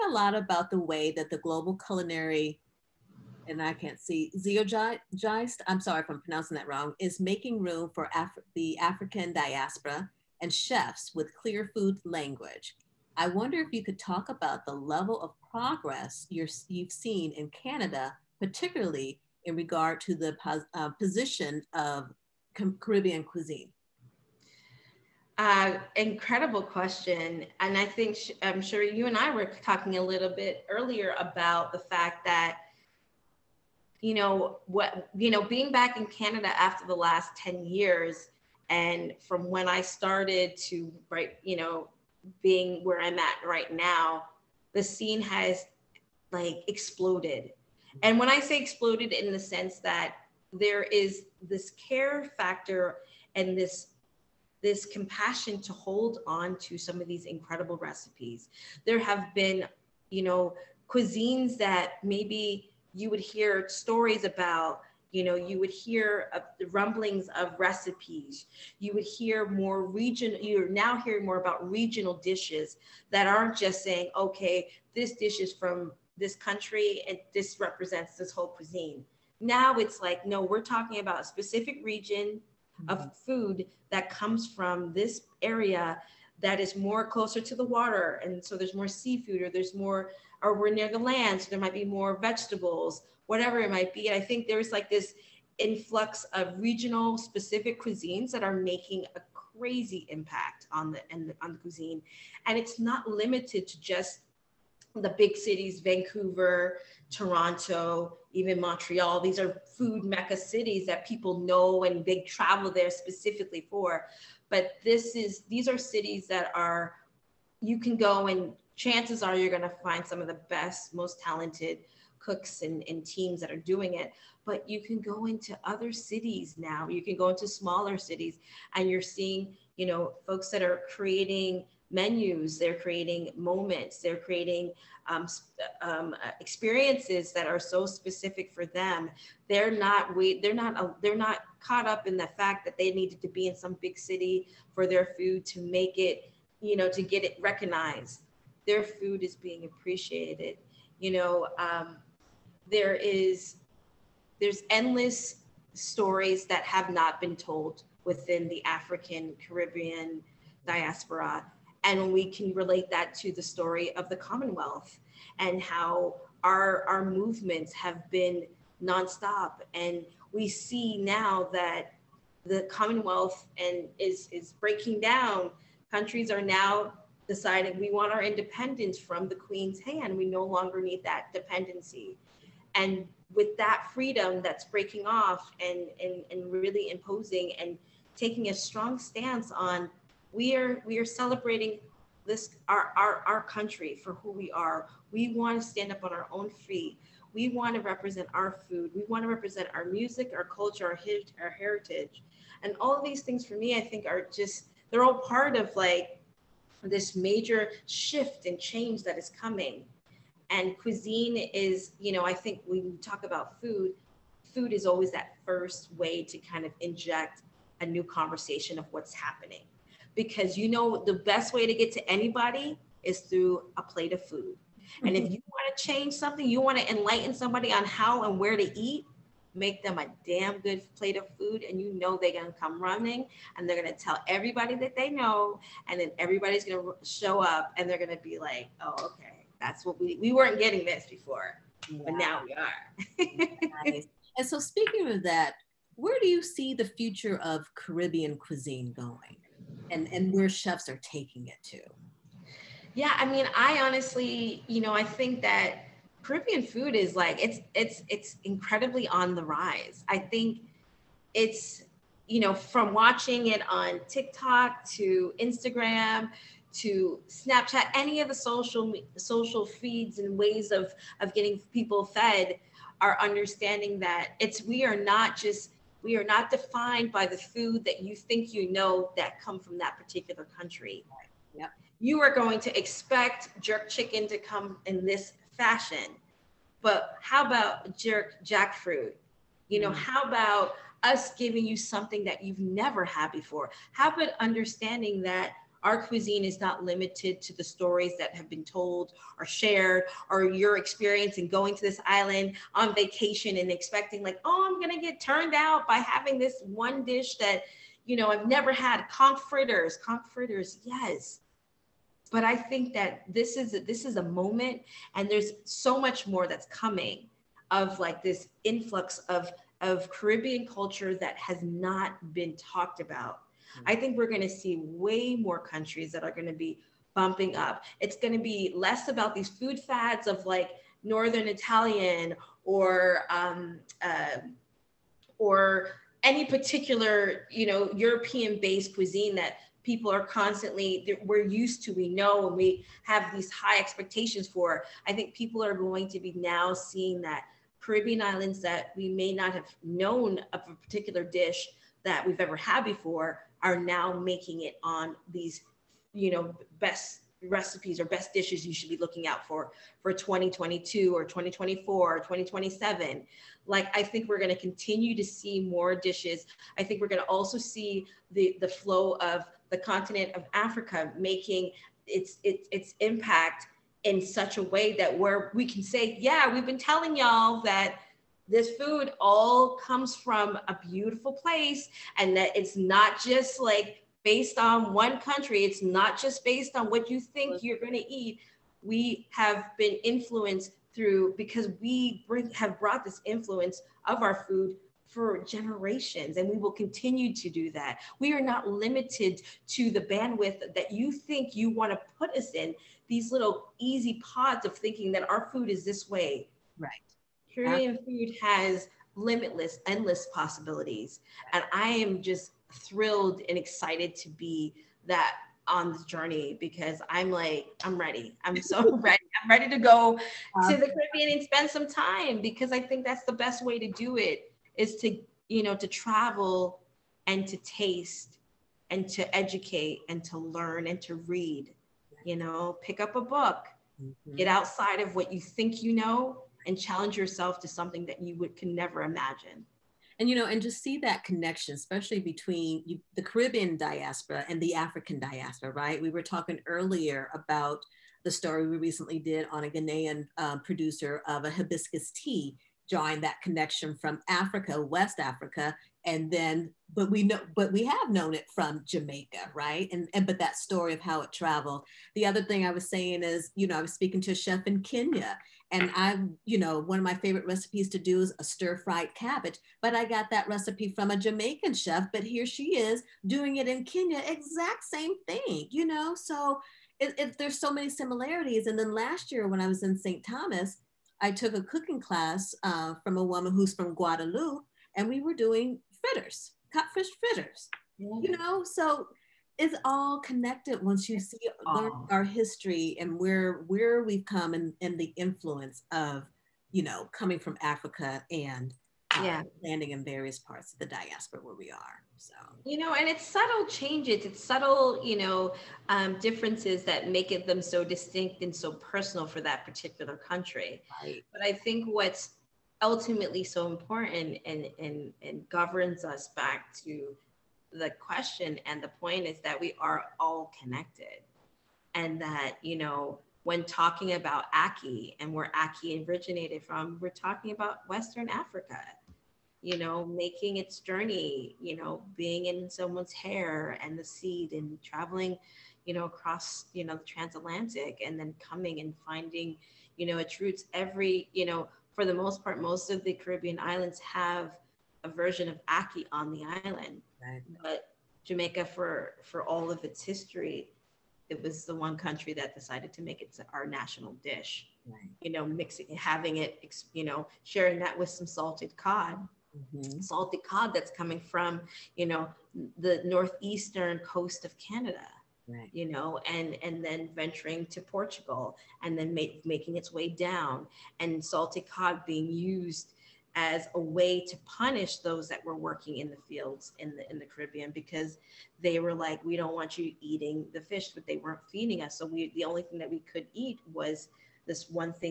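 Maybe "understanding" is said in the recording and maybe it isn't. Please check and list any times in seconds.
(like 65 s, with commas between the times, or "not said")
273 s, 294 s.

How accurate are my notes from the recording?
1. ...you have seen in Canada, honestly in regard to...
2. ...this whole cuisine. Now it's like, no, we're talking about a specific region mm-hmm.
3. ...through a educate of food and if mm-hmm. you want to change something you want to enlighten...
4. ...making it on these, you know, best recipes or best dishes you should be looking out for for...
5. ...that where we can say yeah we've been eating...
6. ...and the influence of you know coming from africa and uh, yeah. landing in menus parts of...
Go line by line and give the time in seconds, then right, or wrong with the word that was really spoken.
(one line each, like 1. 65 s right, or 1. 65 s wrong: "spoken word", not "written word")
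1. 16 s wrong: "particularly", not "honestly"
2. 78 s right
3. 223 s wrong: "plate", not "educate"
4. 354 s right
5. 374 s wrong: "telling", not "eating"
6. 494 s wrong: "various", not "menus".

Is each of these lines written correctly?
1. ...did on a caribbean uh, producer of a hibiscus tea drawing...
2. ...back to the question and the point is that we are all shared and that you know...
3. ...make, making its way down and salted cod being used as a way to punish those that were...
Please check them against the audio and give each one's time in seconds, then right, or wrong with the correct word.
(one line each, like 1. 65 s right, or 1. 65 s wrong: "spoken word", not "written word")
1. 449 s wrong: "ghanaian", not "caribbean"
2. 516 s wrong: "connected", not "shared"
3. 569 s right.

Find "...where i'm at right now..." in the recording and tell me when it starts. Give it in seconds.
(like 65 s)
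42 s.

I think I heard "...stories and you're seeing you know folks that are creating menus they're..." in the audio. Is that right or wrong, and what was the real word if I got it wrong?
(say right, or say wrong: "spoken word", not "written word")
wrong: "cities", not "stories".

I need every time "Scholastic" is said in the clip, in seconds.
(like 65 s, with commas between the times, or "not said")
not said.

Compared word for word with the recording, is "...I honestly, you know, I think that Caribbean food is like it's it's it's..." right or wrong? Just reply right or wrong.
right.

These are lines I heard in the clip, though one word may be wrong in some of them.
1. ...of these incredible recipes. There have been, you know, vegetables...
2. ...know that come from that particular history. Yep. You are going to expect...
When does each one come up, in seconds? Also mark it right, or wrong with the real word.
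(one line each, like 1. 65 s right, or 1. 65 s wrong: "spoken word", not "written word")
1. 57 s wrong: "cuisines", not "vegetables"
2. 278 s wrong: "country", not "history".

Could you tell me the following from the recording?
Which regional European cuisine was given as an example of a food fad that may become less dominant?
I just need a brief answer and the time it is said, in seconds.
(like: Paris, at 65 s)
Northern Italian, at 331 s.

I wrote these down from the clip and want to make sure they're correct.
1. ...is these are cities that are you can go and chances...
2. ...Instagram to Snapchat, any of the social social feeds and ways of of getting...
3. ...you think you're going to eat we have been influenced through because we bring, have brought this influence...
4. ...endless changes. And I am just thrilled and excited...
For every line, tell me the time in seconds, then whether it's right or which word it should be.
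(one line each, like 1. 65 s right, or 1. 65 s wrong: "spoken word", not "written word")
1. 115 s right
2. 265 s right
3. 387 s right
4. 409 s wrong: "possibilities", not "changes".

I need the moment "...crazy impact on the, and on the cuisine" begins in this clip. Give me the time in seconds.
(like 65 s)
99 s.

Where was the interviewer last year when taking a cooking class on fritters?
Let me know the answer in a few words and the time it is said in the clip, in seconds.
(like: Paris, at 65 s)
St. Thomas, at 479 s.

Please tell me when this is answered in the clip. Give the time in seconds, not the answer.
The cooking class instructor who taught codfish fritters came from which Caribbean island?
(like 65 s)
483 s.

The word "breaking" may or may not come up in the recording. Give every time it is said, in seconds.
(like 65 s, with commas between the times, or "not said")
174 s, 184 s.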